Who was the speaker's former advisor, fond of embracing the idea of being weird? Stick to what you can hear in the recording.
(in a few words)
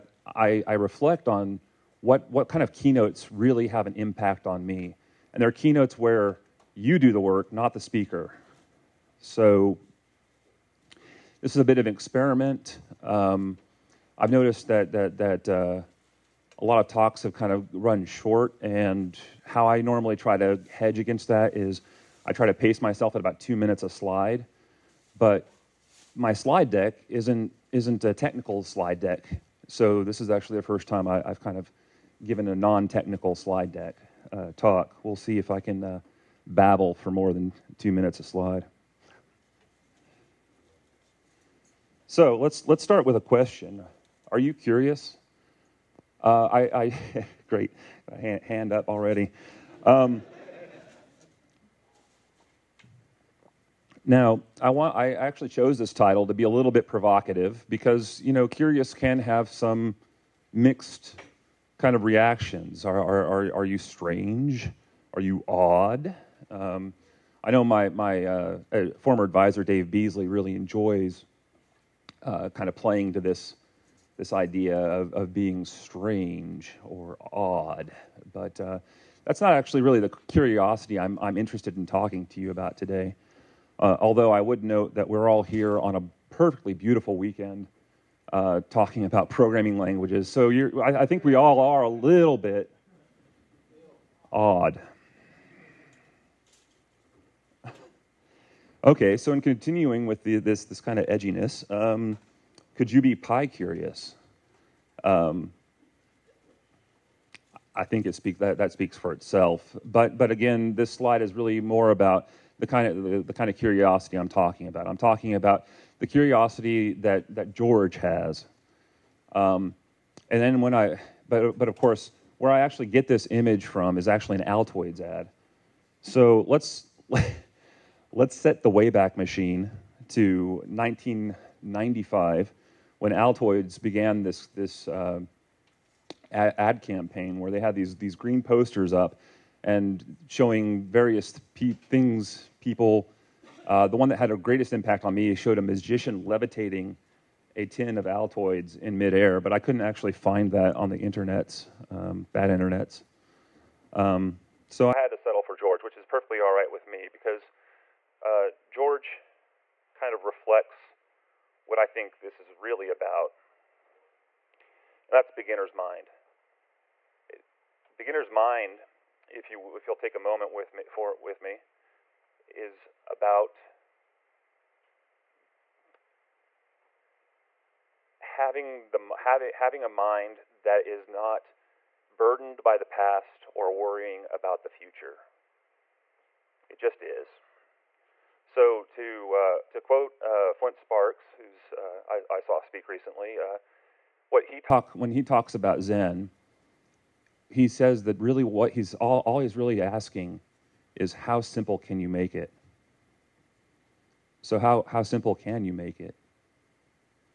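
Dave Beazley.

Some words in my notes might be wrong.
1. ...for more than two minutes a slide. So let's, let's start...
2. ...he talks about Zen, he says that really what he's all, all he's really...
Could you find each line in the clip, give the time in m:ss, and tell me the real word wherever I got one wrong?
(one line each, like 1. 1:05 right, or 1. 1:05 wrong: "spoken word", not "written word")
1. 0:36 right
2. 3:15 right.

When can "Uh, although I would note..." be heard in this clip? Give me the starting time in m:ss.
1:23.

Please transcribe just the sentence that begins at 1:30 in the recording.
So I, I think we all are a little bit odd.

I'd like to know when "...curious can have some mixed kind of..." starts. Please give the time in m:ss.
0:58.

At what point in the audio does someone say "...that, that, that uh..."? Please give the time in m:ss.
0:14.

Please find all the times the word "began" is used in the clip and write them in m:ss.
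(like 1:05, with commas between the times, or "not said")
2:13.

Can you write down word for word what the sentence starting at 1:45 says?
Um, I think it speak, that, that speaks for itself.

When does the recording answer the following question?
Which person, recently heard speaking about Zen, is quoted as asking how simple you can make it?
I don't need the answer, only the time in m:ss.
3:10.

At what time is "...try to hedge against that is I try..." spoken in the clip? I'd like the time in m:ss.
0:20.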